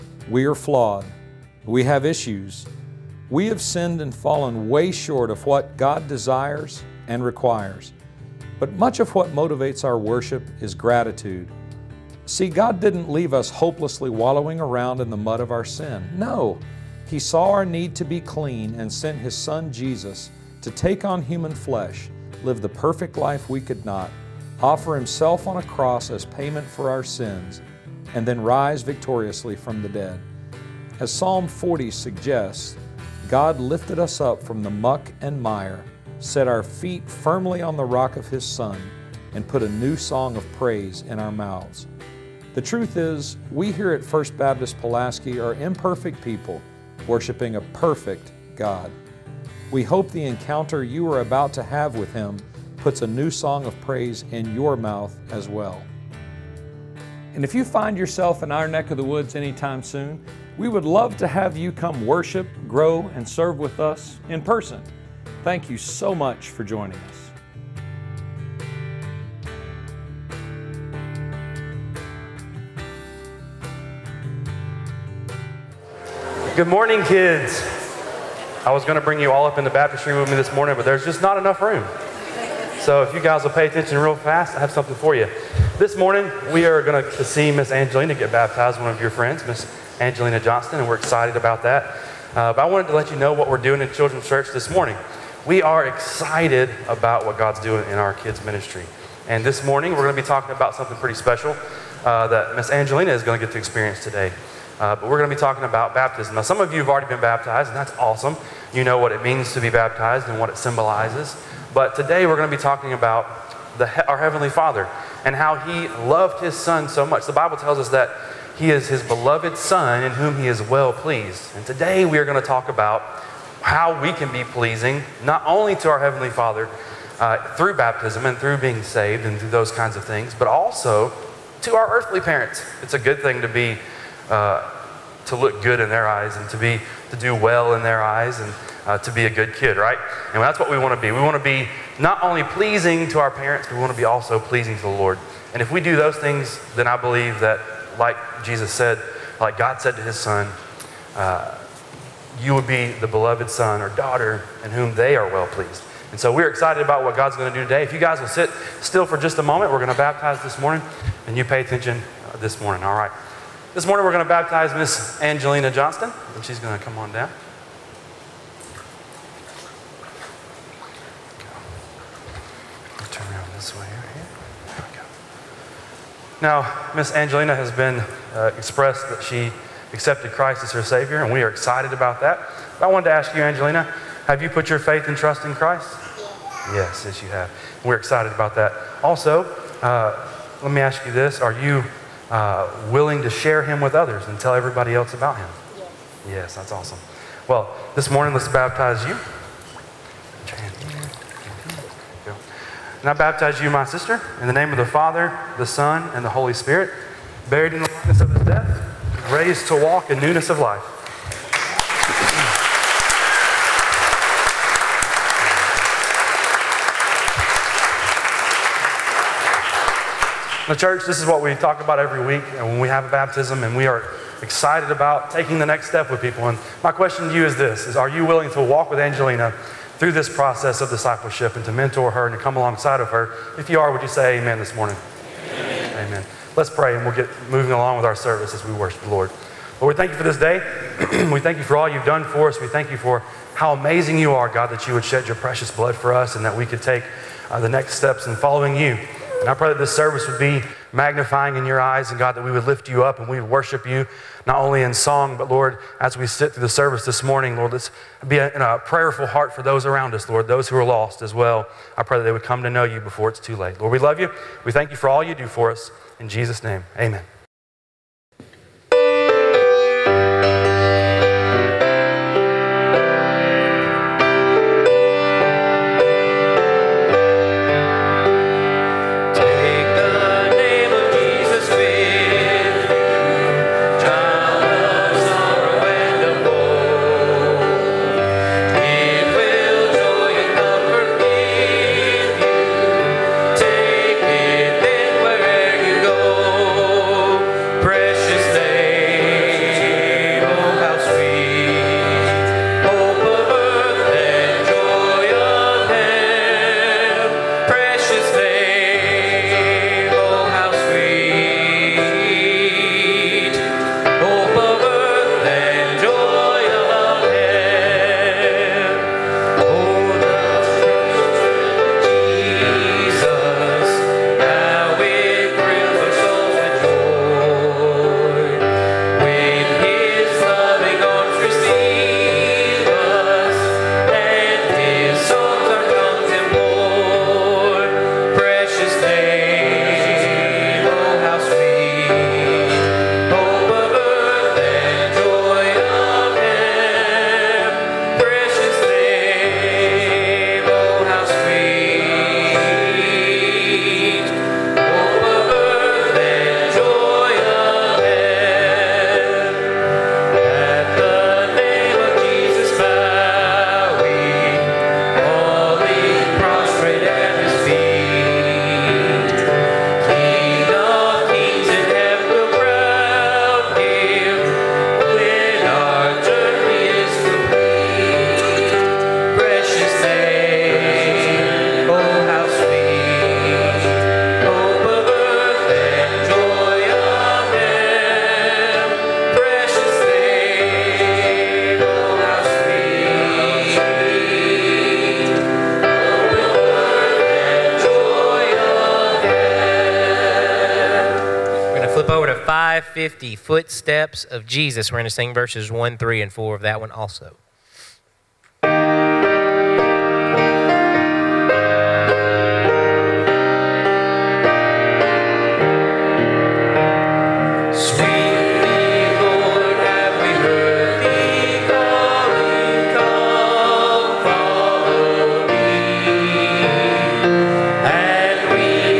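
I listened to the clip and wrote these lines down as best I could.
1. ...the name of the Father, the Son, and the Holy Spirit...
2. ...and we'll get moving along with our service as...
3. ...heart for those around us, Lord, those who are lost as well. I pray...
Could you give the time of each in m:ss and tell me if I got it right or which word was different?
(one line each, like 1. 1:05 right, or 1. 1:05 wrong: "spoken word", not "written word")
1. 3:24 right
2. 3:56 right
3. 4:19 right.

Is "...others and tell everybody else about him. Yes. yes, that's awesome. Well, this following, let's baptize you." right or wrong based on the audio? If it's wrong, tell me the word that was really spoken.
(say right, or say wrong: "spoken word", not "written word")
wrong: "morning", not "following".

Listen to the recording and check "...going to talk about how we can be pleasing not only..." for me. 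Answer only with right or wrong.
right.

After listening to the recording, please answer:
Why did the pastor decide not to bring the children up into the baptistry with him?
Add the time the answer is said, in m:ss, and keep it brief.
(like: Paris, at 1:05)
Not enough room, at 1:20.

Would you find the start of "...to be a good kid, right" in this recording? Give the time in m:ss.
2:18.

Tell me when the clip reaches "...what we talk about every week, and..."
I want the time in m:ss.
3:41.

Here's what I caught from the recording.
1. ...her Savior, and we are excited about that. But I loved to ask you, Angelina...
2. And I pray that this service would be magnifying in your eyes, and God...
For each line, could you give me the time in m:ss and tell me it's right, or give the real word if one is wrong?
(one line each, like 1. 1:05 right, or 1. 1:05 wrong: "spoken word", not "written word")
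1. 3:00 wrong: "wanted", not "loved"
2. 4:09 right.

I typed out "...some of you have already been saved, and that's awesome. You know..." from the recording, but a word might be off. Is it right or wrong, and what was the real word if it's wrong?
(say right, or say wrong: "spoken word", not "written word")
wrong: "baptized", not "saved".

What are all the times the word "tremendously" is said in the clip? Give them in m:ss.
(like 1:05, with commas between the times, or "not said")
not said.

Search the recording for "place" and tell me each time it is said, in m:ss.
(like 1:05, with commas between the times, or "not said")
not said.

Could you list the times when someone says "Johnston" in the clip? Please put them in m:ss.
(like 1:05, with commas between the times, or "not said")
1:30, 2:45.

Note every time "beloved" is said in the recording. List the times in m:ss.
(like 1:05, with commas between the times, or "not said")
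1:59, 2:33.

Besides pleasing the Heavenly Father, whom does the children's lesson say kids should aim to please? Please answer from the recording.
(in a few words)
Earthly parents.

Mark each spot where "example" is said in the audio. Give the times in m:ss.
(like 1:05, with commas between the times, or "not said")
not said.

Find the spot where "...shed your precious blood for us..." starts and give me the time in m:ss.
4:05.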